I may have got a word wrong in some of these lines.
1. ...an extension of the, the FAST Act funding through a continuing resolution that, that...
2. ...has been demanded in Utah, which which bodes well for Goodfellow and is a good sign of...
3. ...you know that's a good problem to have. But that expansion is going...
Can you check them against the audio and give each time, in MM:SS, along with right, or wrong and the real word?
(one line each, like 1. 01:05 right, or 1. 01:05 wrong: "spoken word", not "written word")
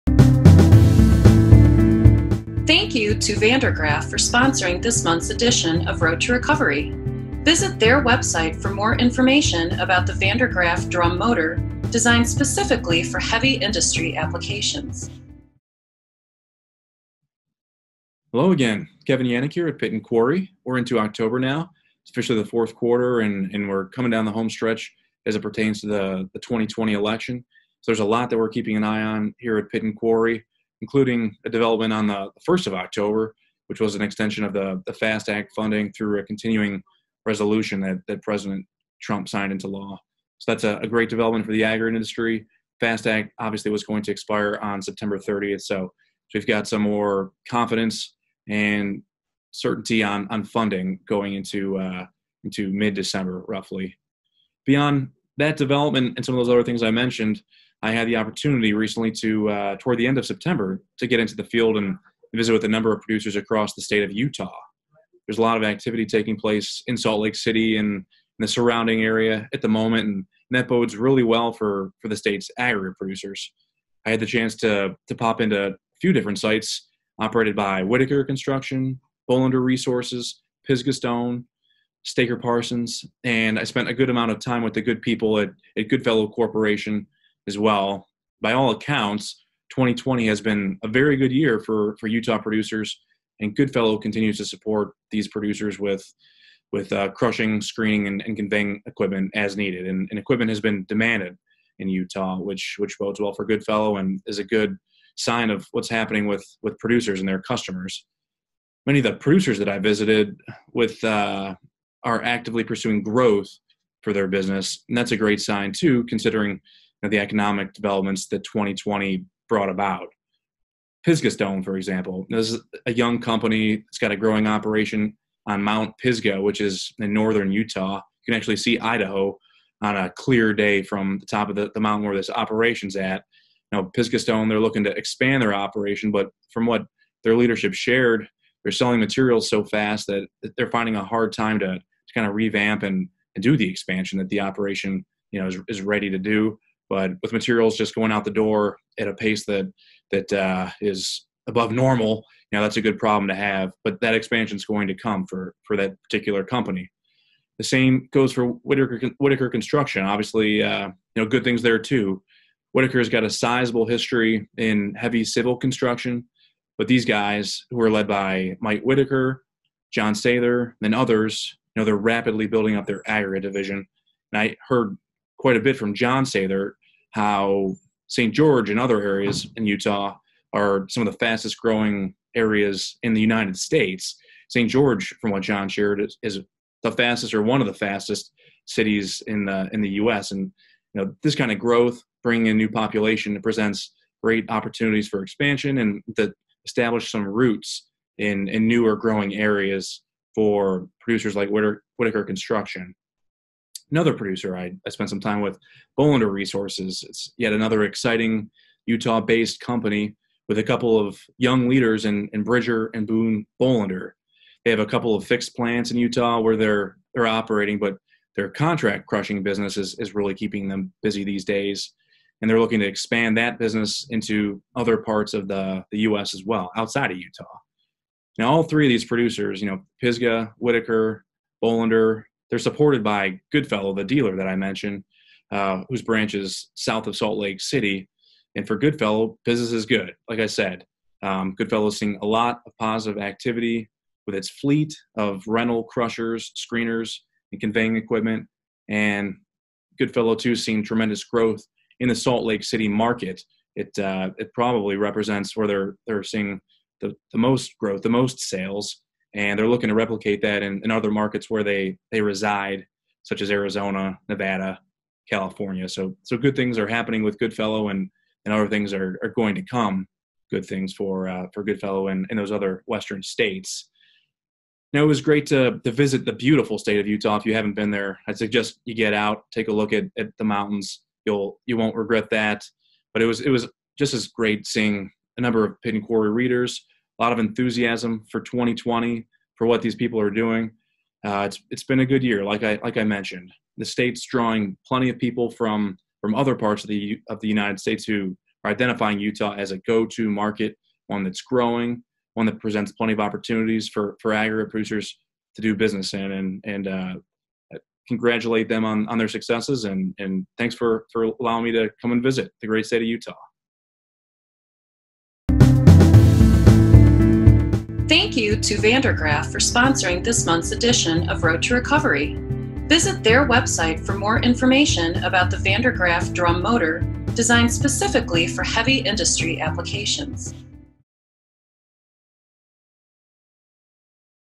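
1. 00:33 right
2. 01:40 right
3. 02:32 right.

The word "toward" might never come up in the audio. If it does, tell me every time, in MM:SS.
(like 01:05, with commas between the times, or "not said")
00:59.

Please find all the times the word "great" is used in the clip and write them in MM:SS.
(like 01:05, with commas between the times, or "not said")
00:40, 01:55, 03:14, 04:35, 04:44, 05:12.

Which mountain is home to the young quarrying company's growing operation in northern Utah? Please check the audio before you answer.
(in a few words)
Mount Pisgah.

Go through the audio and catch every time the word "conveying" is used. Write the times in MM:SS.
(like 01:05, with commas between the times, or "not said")
01:38, 04:07.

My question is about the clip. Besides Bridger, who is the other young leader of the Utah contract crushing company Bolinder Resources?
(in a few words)
Boone Bolinder.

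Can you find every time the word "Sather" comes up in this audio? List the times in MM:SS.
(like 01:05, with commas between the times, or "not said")
02:50, 02:56.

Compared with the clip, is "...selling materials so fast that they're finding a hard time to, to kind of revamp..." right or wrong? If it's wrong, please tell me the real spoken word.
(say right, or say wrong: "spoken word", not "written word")
right.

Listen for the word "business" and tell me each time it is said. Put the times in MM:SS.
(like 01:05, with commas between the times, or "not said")
01:54, 03:39, 03:43, 03:59, 05:05.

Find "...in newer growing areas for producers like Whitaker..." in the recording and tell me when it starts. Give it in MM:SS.
03:18.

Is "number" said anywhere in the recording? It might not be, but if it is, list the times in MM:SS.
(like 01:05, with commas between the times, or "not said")
01:02, 04:45.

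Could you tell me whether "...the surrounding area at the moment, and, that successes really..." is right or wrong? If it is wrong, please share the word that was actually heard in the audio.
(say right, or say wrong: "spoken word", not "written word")
wrong: "bodes", not "successes".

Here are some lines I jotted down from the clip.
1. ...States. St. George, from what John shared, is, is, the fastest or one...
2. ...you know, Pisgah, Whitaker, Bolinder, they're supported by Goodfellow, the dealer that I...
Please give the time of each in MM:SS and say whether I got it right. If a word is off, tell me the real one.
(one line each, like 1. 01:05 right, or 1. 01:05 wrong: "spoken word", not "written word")
1. 03:03 right
2. 03:49 right.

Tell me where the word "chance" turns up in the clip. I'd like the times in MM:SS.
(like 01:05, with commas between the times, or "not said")
01:14.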